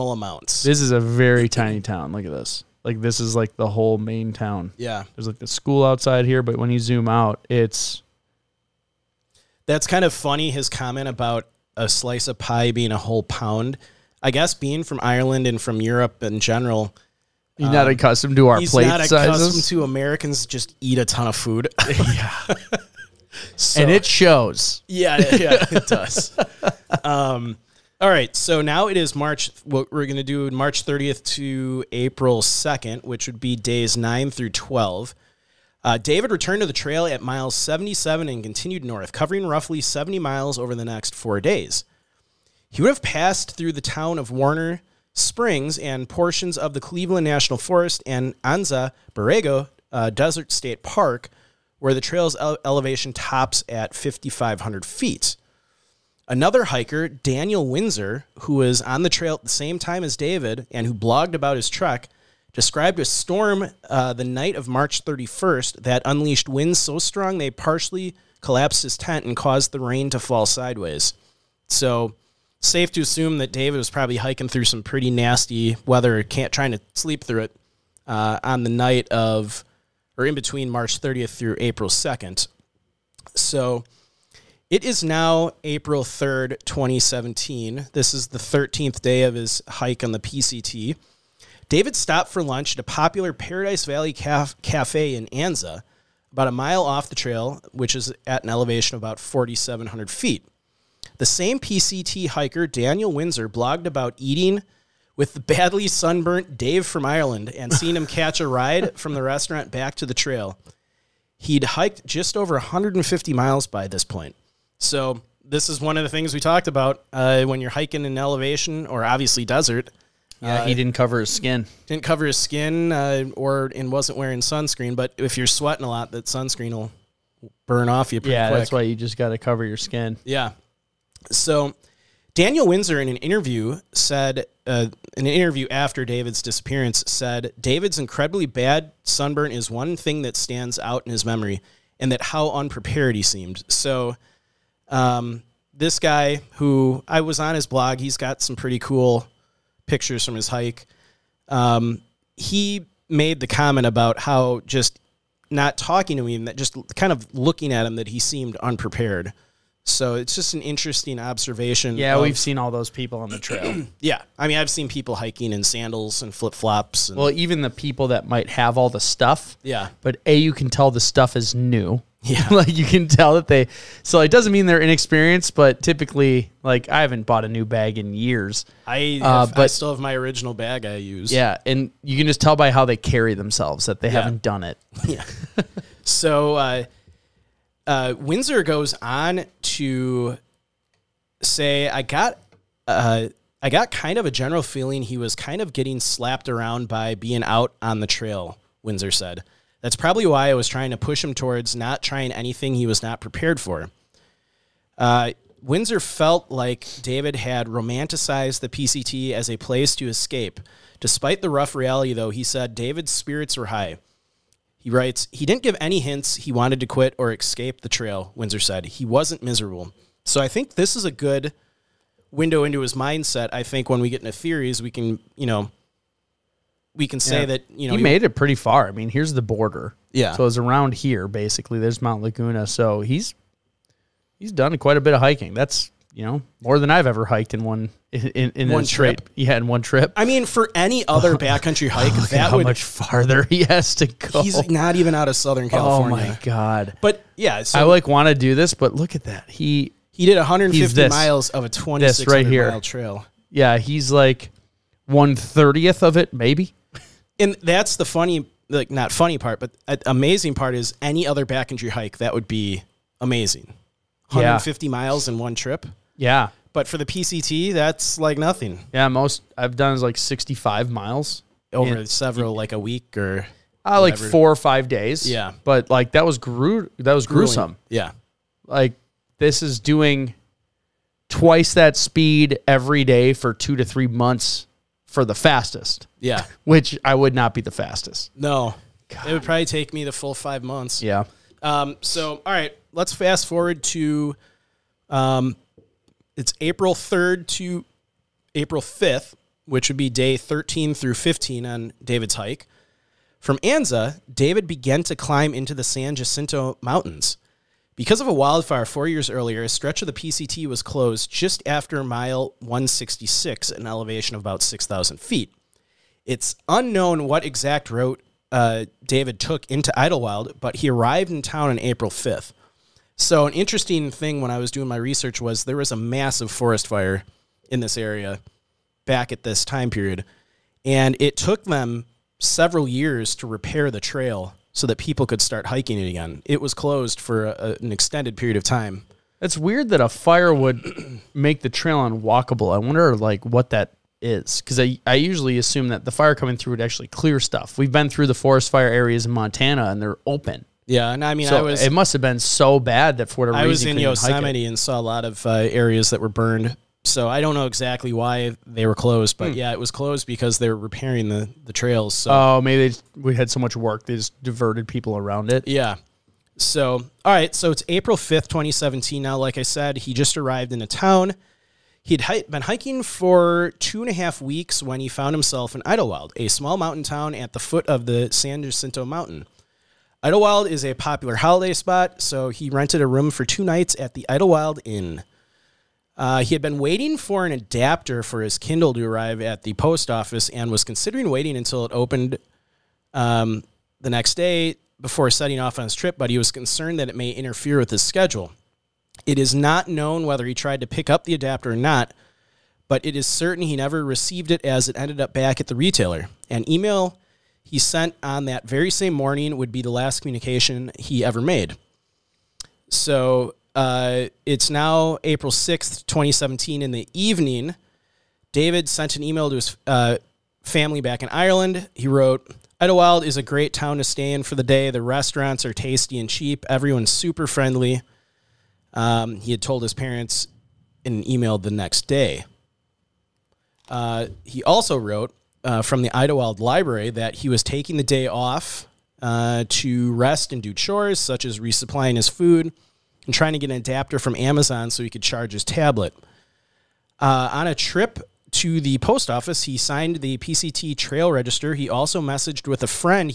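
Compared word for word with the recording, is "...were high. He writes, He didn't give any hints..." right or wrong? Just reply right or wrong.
right.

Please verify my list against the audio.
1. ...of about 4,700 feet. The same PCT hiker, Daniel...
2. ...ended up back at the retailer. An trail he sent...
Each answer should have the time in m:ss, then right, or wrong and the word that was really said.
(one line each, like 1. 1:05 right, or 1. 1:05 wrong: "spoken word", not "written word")
1. 1:38 right
2. 6:44 wrong: "email", not "trail".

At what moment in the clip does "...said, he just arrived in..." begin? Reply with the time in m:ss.
6:09.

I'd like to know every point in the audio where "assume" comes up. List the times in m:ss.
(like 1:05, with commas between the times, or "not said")
1:13, 5:45.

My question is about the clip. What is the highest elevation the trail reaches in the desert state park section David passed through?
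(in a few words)
5,500 feet.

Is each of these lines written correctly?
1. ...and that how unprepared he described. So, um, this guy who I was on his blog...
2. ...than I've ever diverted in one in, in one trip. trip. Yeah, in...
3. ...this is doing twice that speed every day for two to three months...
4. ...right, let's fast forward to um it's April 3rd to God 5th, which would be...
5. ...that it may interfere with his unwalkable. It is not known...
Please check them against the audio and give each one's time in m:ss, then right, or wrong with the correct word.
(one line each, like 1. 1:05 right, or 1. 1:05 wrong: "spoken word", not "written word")
1. 2:21 wrong: "seemed", not "described"
2. 3:56 wrong: "hiked", not "diverted"
3. 4:39 right
4. 4:52 wrong: "April", not "God"
5. 6:36 wrong: "schedule", not "unwalkable".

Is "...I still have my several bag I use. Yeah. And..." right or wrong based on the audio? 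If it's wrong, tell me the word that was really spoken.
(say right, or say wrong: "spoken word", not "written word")
wrong: "original", not "several".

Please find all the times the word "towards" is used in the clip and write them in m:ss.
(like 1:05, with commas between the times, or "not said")
3:21.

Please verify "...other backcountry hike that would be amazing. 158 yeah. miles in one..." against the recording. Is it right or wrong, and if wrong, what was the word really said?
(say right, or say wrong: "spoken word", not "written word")
wrong: "150", not "158".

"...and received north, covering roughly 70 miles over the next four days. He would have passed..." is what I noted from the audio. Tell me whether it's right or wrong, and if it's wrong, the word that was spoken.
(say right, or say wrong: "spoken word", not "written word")
wrong: "continued", not "received".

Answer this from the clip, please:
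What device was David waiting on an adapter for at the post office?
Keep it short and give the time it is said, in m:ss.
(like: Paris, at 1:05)
Kindle, at 6:28.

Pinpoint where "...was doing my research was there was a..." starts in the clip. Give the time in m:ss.
5:24.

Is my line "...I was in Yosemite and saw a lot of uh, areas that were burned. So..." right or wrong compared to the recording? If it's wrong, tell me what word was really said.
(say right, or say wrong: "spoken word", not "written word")
right.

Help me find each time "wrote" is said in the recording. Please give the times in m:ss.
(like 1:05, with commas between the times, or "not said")
7:02, 7:14.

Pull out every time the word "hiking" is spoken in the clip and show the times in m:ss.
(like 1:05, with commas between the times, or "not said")
1:14, 1:57, 2:45, 3:55, 5:35, 6:12.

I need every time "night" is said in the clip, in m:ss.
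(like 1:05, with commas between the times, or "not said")
1:04, 1:18, 6:23.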